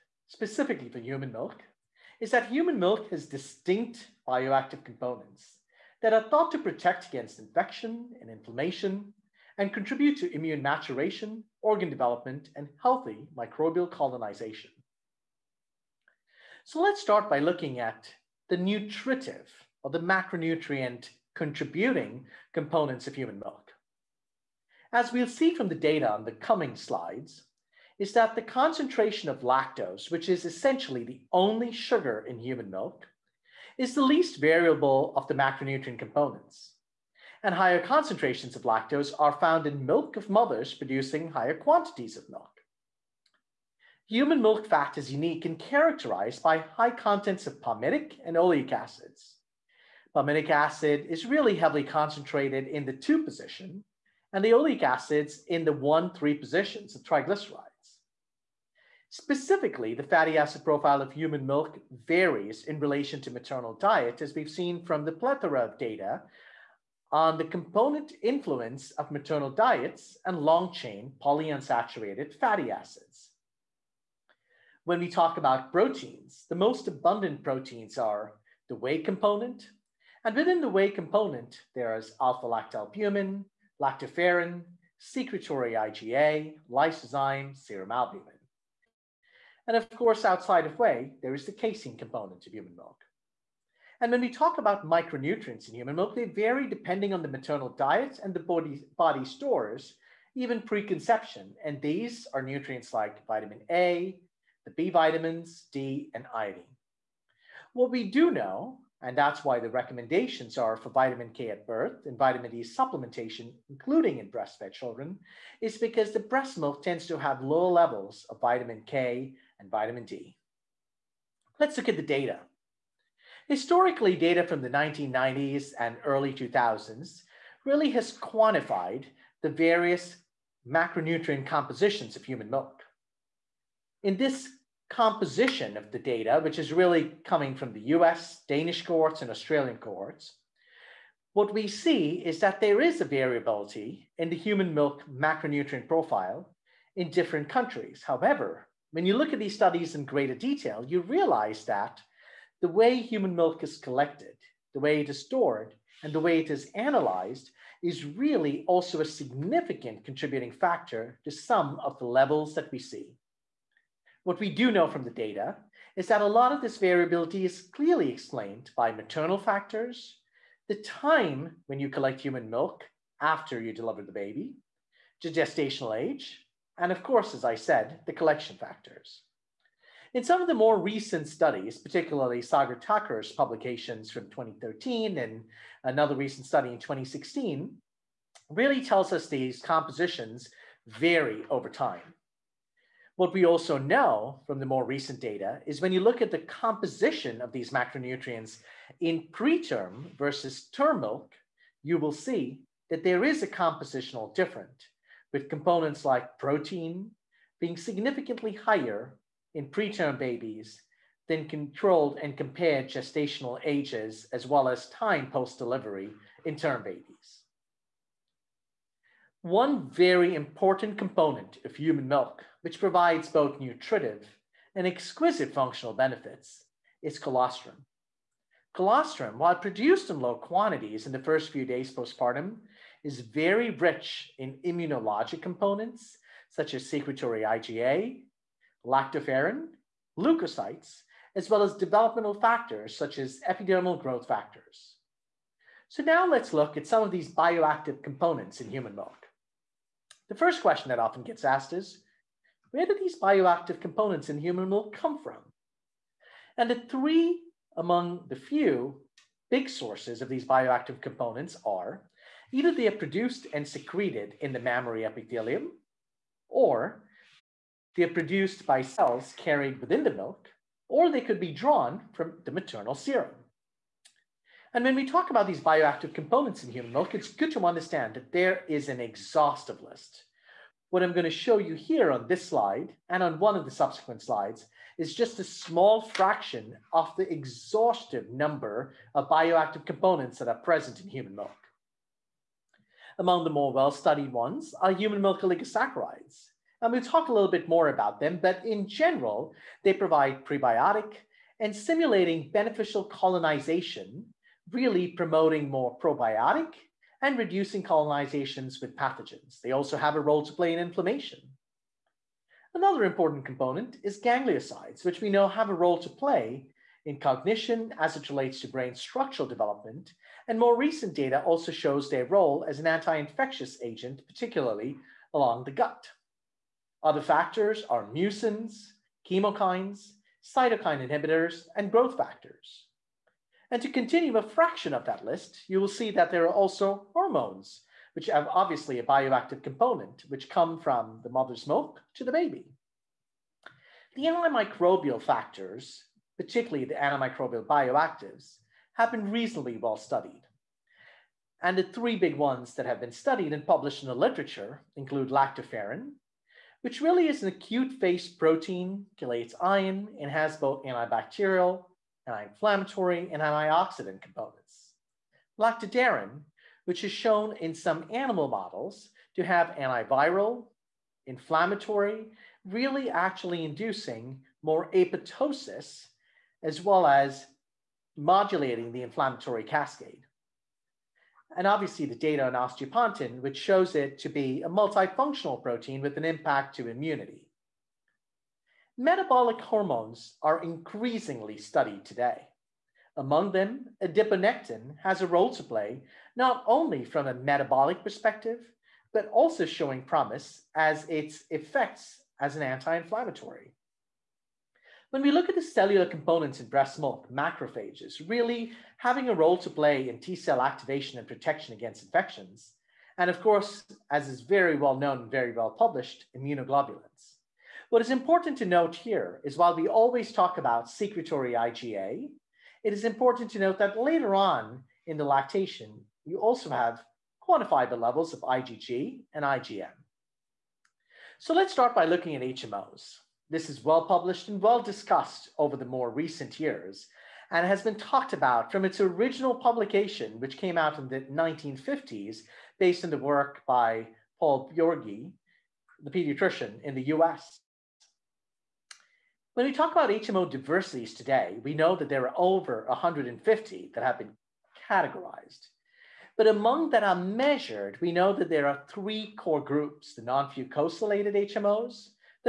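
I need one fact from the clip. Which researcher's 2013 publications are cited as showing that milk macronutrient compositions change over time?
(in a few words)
Sagar Thakur.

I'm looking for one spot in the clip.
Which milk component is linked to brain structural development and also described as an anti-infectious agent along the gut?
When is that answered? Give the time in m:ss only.
5:14.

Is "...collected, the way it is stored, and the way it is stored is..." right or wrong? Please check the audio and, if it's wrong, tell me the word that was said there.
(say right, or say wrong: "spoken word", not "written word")
wrong: "analyzed", not "stored".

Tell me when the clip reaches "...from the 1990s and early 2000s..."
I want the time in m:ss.
2:04.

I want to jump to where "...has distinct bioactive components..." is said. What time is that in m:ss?
0:03.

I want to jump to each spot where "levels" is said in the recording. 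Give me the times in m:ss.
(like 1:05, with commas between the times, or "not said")
1:57, 2:42, 7:08.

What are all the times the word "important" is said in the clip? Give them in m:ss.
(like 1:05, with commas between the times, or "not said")
3:40, 5:13, 6:58, 7:03.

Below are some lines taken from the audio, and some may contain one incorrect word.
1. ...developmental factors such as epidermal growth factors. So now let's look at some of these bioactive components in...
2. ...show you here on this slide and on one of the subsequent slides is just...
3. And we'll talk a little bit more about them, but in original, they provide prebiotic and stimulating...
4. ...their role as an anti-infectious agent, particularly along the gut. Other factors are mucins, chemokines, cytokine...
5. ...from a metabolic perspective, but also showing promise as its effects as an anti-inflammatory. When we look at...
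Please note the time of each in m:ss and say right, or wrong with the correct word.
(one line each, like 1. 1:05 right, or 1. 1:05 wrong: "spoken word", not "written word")
1. 4:01 right
2. 4:41 right
3. 4:56 wrong: "general", not "original"
4. 5:22 right
5. 6:37 right.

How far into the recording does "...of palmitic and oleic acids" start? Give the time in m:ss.
0:47.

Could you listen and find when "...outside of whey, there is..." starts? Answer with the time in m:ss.
1:30.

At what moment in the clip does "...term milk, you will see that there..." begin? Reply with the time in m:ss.
3:20.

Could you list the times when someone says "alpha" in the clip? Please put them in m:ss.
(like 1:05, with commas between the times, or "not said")
1:22.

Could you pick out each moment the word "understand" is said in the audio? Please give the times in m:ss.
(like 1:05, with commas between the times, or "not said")
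4:37.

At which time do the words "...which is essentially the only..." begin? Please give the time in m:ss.
0:30.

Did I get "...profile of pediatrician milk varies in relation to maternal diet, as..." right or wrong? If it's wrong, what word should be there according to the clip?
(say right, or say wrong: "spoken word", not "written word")
wrong: "human", not "pediatrician".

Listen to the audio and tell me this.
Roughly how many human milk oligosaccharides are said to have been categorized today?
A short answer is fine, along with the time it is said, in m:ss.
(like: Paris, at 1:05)
Over 150, at 7:32.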